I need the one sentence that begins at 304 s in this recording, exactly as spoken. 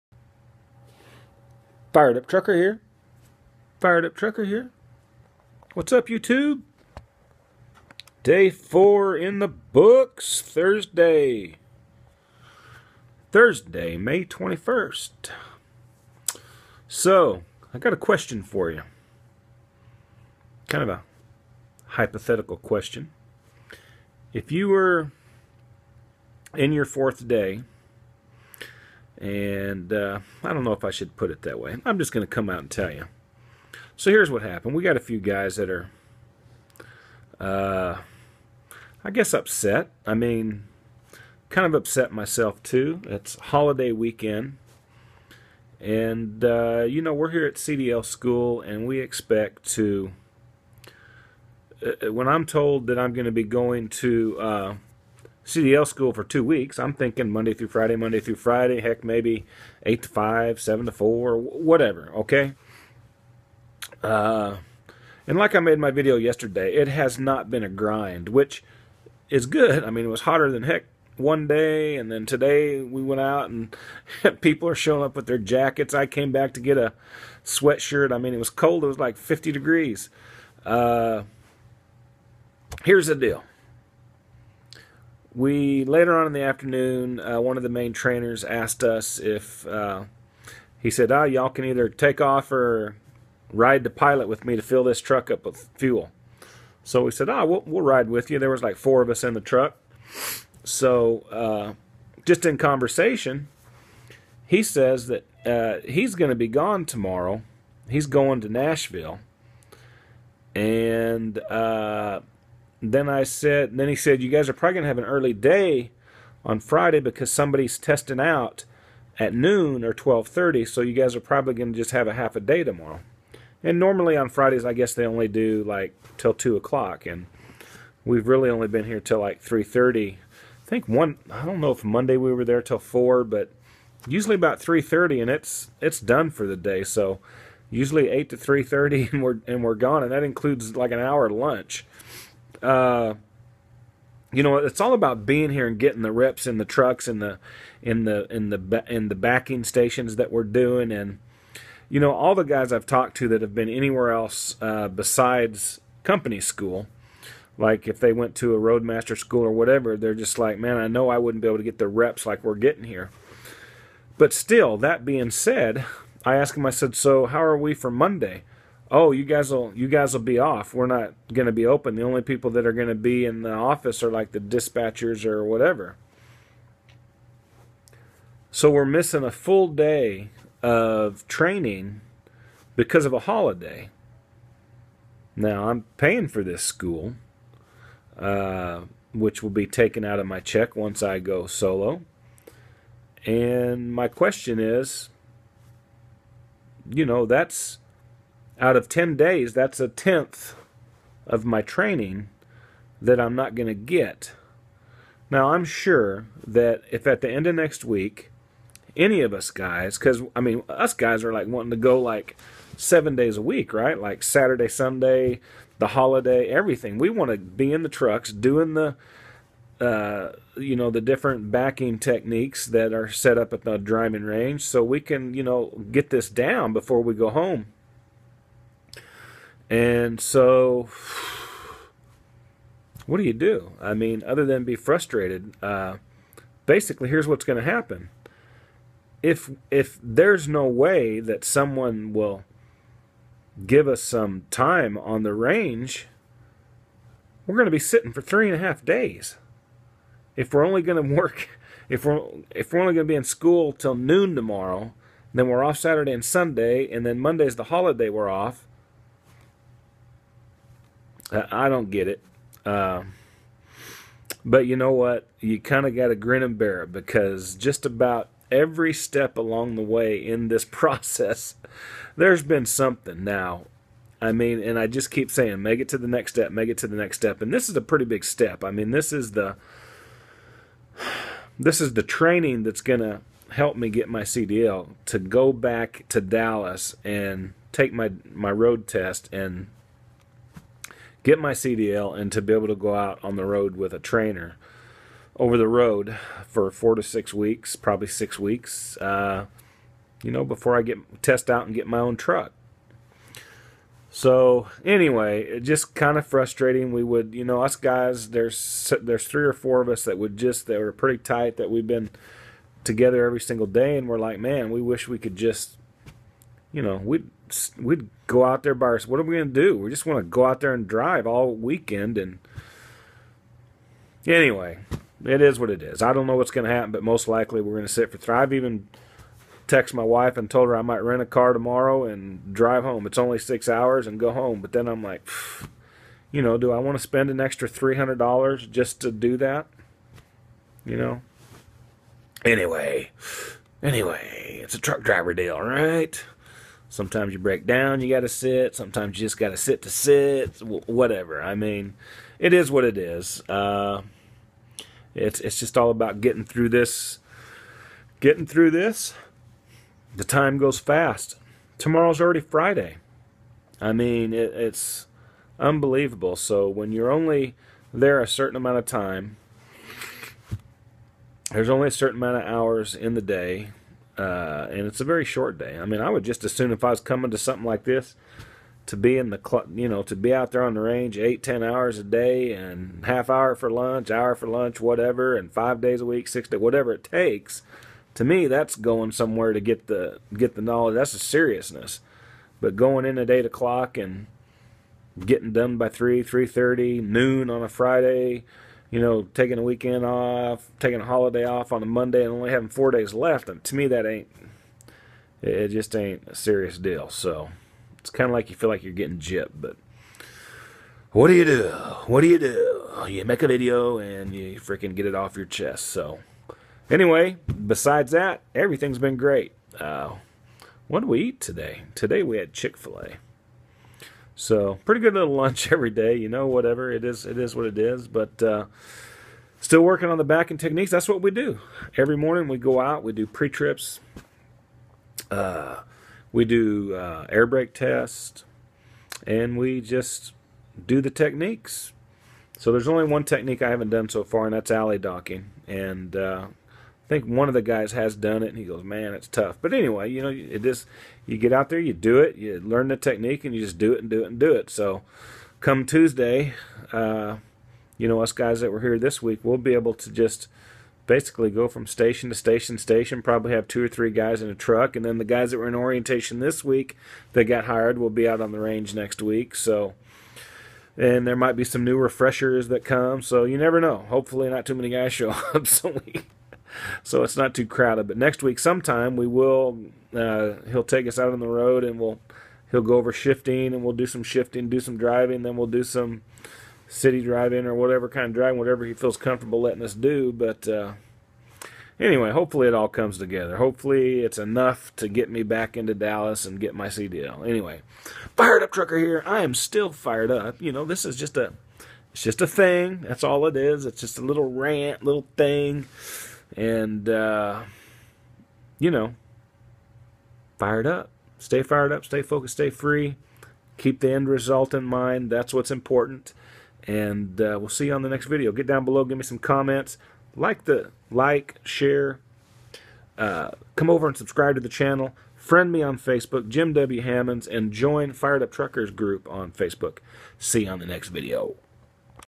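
So anyway, just kind of frustrating.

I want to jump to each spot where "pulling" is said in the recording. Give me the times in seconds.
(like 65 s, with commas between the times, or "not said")
not said.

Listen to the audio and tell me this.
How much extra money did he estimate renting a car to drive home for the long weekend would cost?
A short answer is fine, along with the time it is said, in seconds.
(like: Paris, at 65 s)
$300, at 337 s.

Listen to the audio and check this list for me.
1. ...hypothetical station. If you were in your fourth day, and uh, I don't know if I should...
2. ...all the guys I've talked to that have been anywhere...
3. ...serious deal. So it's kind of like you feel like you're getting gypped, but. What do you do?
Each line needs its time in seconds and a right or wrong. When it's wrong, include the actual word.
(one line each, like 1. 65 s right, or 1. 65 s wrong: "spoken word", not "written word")
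1. 21 s wrong: "question", not "station"
2. 152 s right
3. 406 s right.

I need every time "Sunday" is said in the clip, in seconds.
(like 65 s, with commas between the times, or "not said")
214 s, 256 s.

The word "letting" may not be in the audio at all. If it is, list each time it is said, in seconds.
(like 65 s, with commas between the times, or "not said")
489 s.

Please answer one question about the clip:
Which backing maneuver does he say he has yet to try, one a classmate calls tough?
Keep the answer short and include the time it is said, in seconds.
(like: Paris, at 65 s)
Alley docking, at 444 s.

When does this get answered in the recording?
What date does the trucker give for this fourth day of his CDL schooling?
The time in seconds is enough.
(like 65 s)
13 s.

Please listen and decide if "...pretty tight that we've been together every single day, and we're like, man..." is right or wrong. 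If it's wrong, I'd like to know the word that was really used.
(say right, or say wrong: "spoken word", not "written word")
right.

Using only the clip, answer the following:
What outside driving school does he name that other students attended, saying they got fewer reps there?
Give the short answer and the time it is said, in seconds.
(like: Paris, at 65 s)
Roadmaster, at 158 s.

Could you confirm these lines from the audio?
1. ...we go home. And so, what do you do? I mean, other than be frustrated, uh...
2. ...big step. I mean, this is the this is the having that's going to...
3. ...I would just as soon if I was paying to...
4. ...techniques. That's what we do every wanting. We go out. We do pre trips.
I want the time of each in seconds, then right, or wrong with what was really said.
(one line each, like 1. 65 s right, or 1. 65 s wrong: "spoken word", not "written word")
1. 227 s right
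2. 278 s wrong: "training", not "having"
3. 376 s wrong: "coming", not "paying"
4. 430 s wrong: "morning", not "wanting".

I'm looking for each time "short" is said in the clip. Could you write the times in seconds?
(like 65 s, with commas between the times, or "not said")
375 s.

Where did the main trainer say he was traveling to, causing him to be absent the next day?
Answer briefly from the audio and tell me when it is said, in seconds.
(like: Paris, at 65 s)
Nashville, at 108 s.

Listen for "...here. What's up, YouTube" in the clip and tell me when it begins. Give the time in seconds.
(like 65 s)
4 s.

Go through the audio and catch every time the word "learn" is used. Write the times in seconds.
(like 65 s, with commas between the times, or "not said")
452 s.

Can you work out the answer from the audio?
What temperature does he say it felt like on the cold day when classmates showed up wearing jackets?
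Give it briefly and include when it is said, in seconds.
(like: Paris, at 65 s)
50 degrees, at 79 s.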